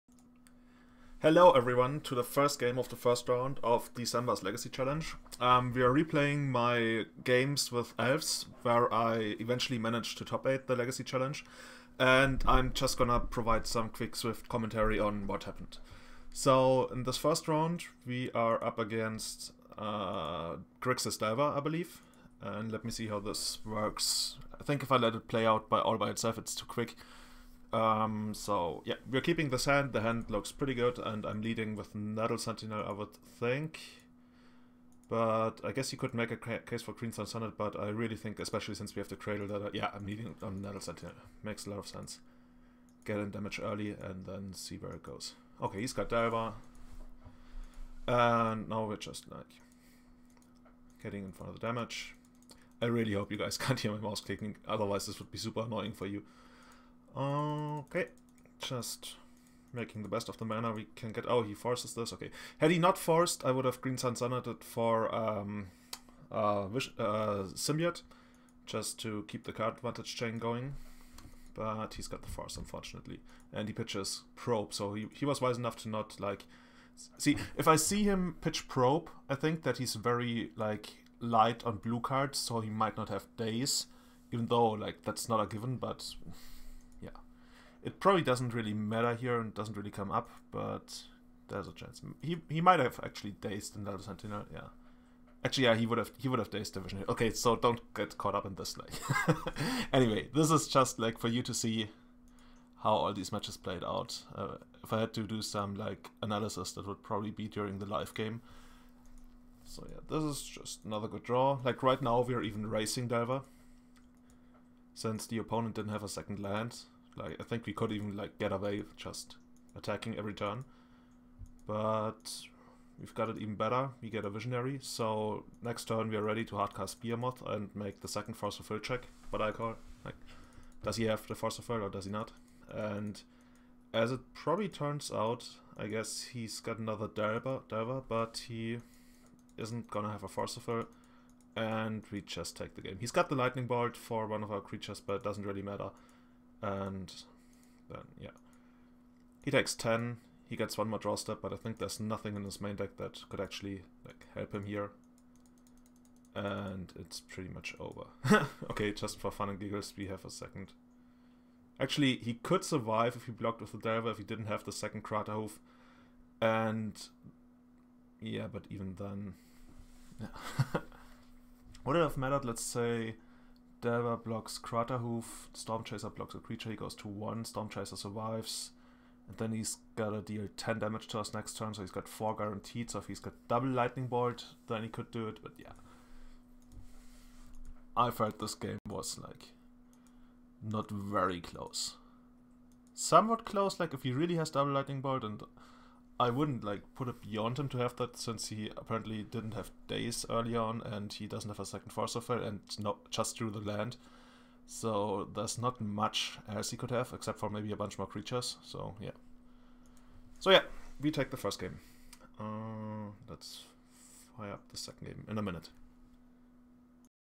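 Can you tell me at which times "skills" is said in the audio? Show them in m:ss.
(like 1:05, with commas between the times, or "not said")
not said.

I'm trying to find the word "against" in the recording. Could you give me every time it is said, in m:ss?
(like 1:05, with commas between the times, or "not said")
0:18.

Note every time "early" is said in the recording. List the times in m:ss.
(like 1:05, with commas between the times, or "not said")
0:43, 3:20.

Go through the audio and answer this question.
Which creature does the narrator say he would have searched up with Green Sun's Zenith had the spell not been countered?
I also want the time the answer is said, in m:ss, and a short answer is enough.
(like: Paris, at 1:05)
Symbiote, at 1:07.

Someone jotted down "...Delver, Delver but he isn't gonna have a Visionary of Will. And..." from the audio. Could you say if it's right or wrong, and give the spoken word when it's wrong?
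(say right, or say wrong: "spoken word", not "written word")
wrong: "Force", not "Visionary".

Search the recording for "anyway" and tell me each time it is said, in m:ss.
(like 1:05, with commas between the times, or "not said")
1:39.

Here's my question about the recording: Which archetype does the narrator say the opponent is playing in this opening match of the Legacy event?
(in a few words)
Grixis Delver.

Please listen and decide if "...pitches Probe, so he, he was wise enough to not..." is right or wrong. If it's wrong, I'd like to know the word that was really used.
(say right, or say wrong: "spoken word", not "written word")
right.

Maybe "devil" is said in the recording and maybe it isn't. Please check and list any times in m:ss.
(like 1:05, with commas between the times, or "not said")
not said.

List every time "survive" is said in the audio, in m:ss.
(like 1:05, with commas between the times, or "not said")
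2:42, 2:57.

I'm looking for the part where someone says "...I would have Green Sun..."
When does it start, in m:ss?
1:03.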